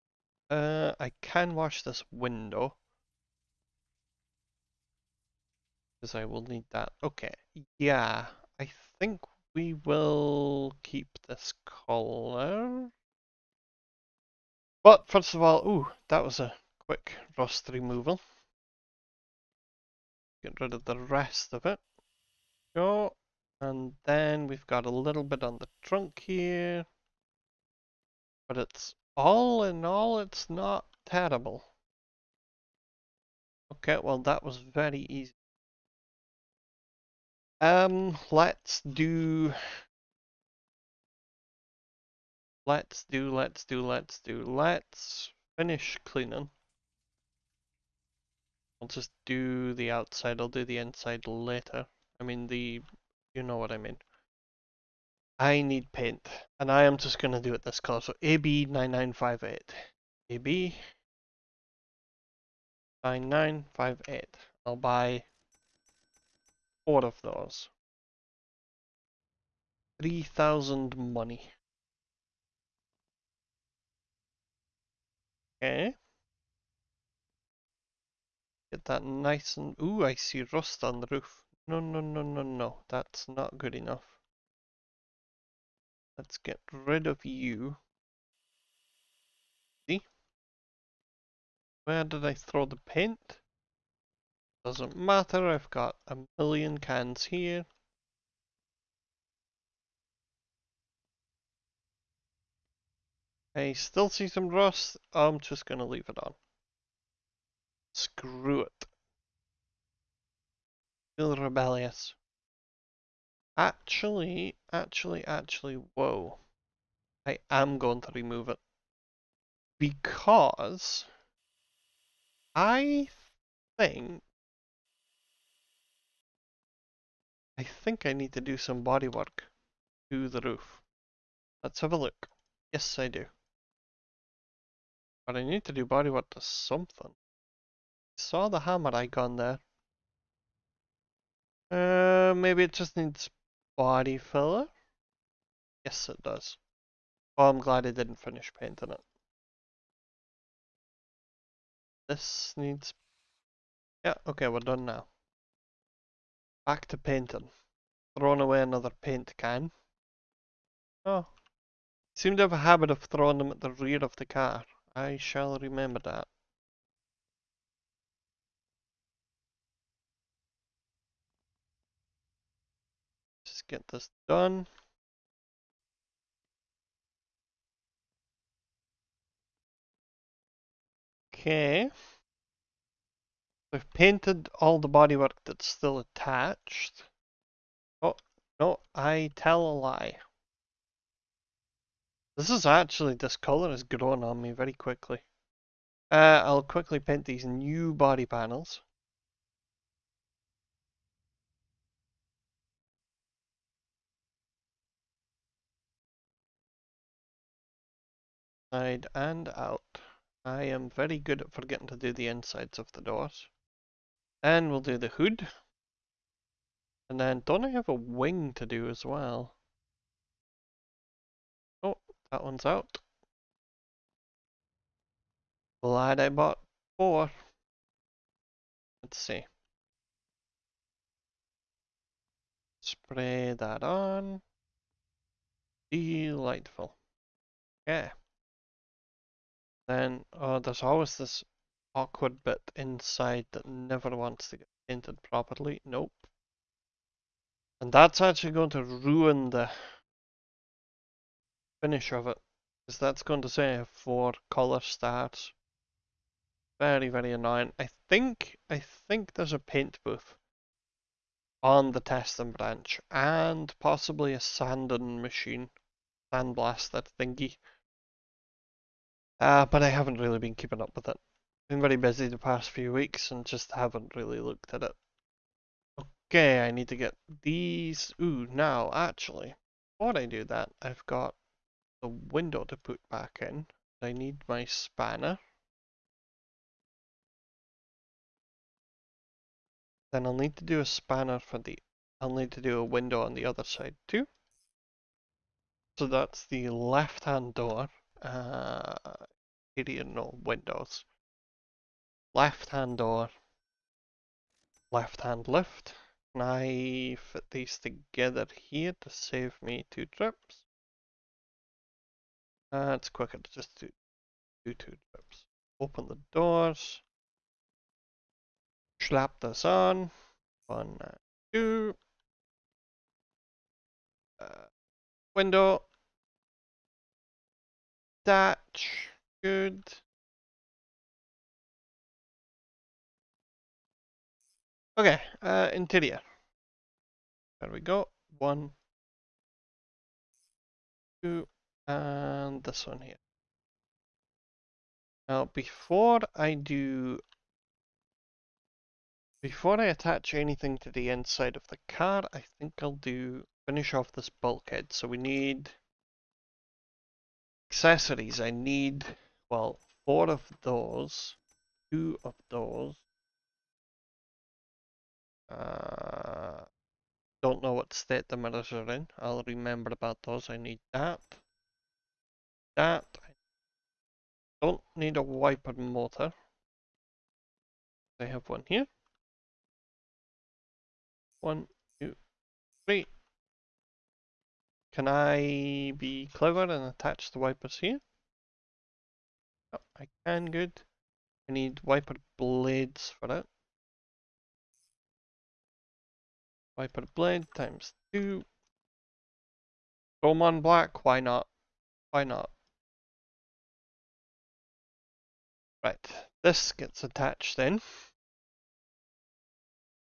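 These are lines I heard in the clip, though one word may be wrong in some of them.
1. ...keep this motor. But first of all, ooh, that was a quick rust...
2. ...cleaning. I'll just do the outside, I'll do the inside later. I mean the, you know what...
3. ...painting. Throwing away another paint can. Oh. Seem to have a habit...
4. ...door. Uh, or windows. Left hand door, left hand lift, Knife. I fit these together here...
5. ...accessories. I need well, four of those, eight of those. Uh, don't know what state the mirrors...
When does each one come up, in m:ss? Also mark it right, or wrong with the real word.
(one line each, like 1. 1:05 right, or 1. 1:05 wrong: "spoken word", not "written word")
1. 0:10 wrong: "color", not "motor"
2. 0:46 right
3. 2:36 right
4. 4:57 right
5. 5:57 wrong: "two", not "eight".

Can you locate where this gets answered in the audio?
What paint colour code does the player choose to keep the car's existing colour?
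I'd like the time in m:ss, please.
0:58.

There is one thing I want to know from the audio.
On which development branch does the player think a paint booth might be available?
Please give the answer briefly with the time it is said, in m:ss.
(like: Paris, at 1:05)
Testing branch, at 4:22.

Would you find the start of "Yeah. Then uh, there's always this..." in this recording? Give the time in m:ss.
3:57.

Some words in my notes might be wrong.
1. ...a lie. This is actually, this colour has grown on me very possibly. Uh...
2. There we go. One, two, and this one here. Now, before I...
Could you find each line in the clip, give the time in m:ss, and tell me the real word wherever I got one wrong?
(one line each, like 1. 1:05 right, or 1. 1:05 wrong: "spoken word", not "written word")
1. 3:09 wrong: "quickly", not "possibly"
2. 5:37 right.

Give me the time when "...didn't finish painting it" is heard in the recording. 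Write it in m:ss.
2:27.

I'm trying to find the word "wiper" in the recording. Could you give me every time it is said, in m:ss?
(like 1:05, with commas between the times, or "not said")
6:15, 6:27, 6:31, 6:36.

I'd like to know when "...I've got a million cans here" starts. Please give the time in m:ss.
1:35.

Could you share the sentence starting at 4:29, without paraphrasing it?
Uh, but I haven't really been keeping up with it.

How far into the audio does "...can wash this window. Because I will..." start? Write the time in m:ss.
0:01.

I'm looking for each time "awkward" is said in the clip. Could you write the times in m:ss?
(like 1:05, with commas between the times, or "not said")
4:01.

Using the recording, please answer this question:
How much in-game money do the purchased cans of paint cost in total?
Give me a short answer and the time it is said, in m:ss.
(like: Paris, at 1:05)
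3,000, at 1:10.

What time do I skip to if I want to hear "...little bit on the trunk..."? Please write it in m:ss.
0:24.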